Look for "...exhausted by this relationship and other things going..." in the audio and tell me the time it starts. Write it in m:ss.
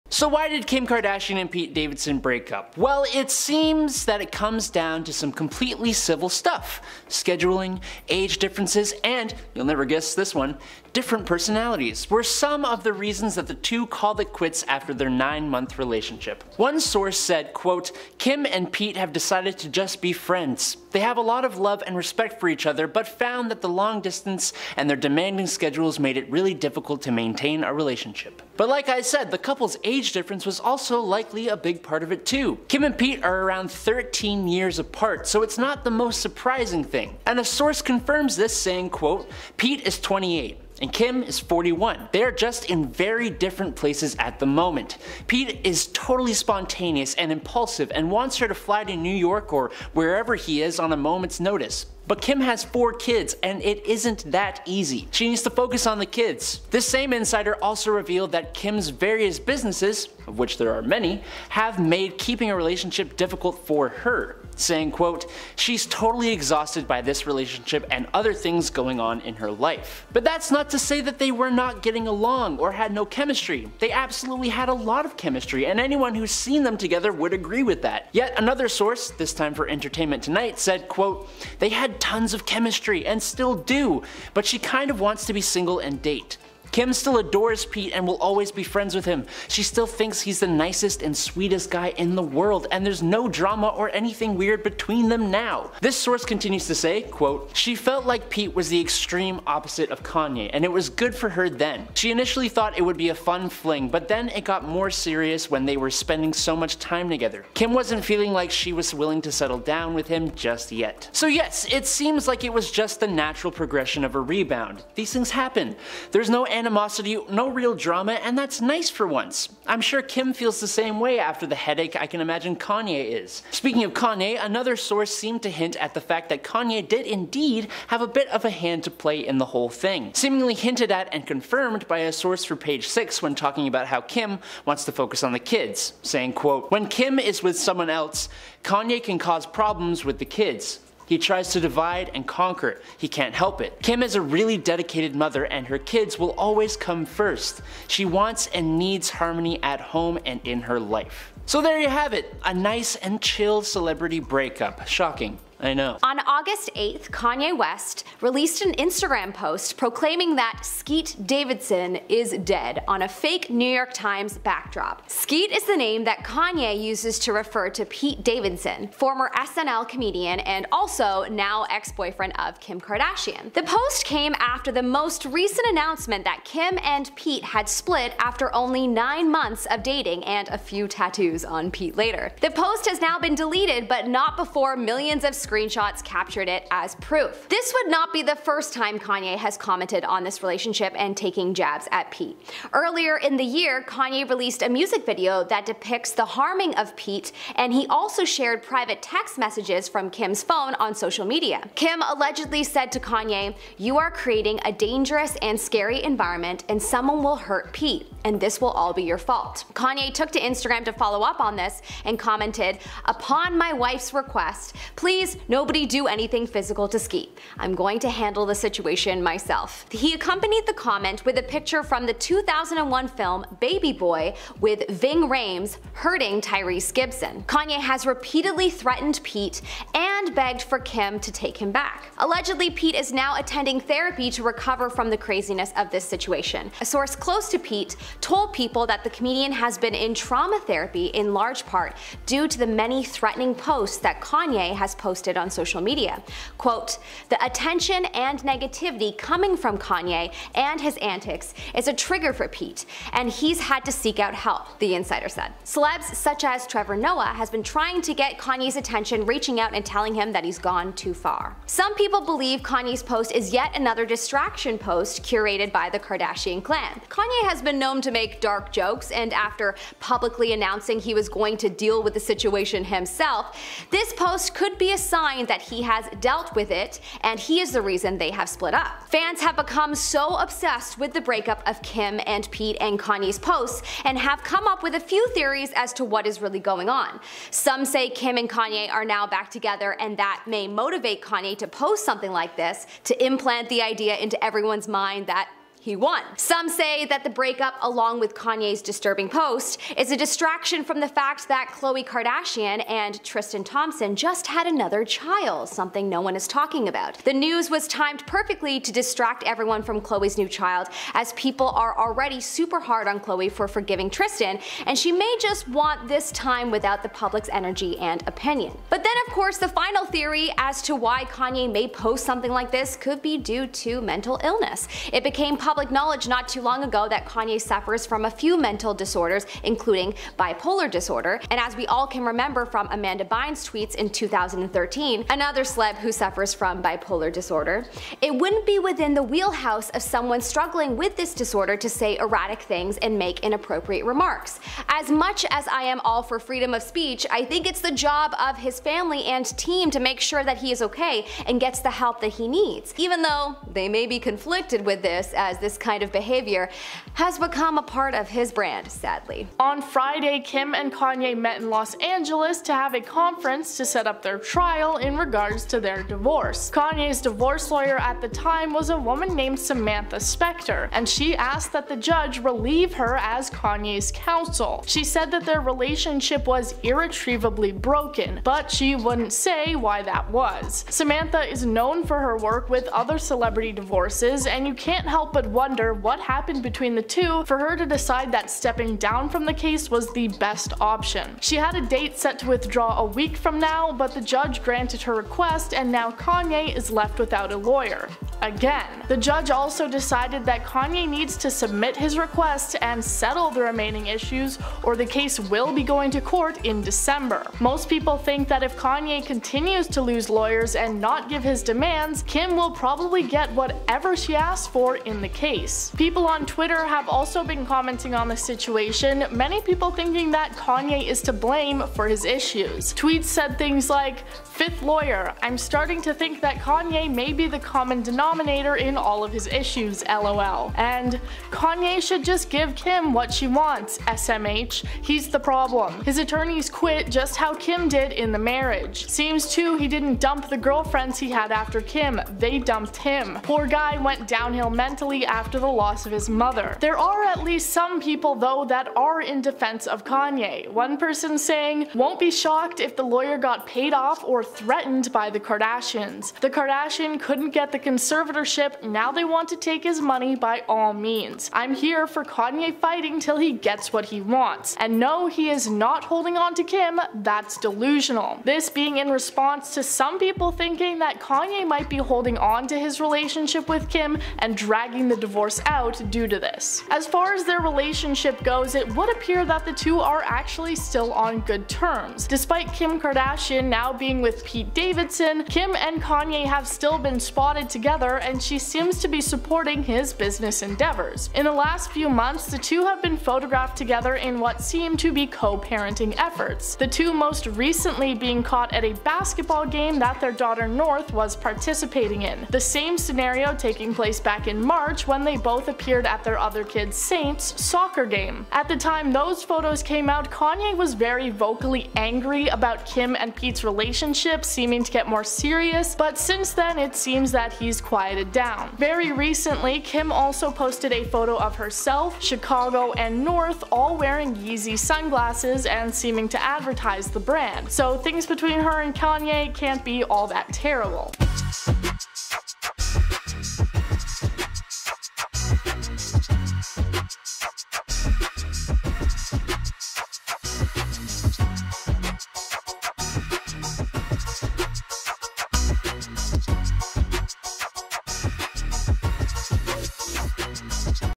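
1:06.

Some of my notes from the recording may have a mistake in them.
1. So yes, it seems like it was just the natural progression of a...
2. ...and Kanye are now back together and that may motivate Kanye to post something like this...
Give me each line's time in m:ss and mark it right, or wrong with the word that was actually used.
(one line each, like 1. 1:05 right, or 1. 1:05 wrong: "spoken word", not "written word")
1. 1:51 right
2. 4:48 right.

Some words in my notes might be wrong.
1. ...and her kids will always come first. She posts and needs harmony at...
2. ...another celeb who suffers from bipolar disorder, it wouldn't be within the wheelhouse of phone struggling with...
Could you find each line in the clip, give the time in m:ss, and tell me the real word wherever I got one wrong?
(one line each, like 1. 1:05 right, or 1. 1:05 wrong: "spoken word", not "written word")
1. 2:25 wrong: "wants", not "posts"
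2. 5:35 wrong: "someone", not "phone".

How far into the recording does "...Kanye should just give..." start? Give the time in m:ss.
7:11.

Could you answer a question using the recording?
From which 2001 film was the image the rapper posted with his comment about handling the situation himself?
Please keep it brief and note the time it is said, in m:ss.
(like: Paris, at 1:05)
Baby Boy, at 3:43.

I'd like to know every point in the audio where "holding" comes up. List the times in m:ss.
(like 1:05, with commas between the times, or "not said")
7:46, 7:51.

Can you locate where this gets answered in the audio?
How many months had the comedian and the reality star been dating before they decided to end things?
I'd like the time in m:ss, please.
0:15.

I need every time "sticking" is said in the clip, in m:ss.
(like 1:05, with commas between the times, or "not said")
not said.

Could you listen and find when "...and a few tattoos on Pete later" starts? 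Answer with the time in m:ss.
3:00.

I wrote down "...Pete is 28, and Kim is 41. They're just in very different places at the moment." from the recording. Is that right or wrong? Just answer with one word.
right.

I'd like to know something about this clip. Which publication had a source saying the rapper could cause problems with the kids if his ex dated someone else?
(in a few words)
Page 6.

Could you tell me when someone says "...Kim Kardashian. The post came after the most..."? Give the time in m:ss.
2:52.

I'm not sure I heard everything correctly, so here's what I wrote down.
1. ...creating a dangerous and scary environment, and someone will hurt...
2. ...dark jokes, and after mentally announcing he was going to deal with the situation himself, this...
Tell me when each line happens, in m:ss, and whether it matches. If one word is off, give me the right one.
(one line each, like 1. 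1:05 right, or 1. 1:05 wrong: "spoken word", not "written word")
1. 3:24 right
2. 4:28 wrong: "publicly", not "mentally".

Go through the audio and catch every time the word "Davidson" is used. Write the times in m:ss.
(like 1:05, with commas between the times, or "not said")
0:01, 2:41, 2:48, 8:04.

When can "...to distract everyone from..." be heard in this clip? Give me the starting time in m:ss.
5:08.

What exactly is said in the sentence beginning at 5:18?
But then, of course, the final theory as to why Kanye may post something like this could be due to mental illness.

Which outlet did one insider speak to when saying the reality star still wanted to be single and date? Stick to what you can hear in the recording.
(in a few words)
Entertainment Tonight.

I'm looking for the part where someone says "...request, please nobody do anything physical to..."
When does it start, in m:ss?
3:34.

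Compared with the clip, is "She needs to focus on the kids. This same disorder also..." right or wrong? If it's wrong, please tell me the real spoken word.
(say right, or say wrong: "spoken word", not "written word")
wrong: "insider", not "disorder".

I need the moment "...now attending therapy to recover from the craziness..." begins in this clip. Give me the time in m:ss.
3:53.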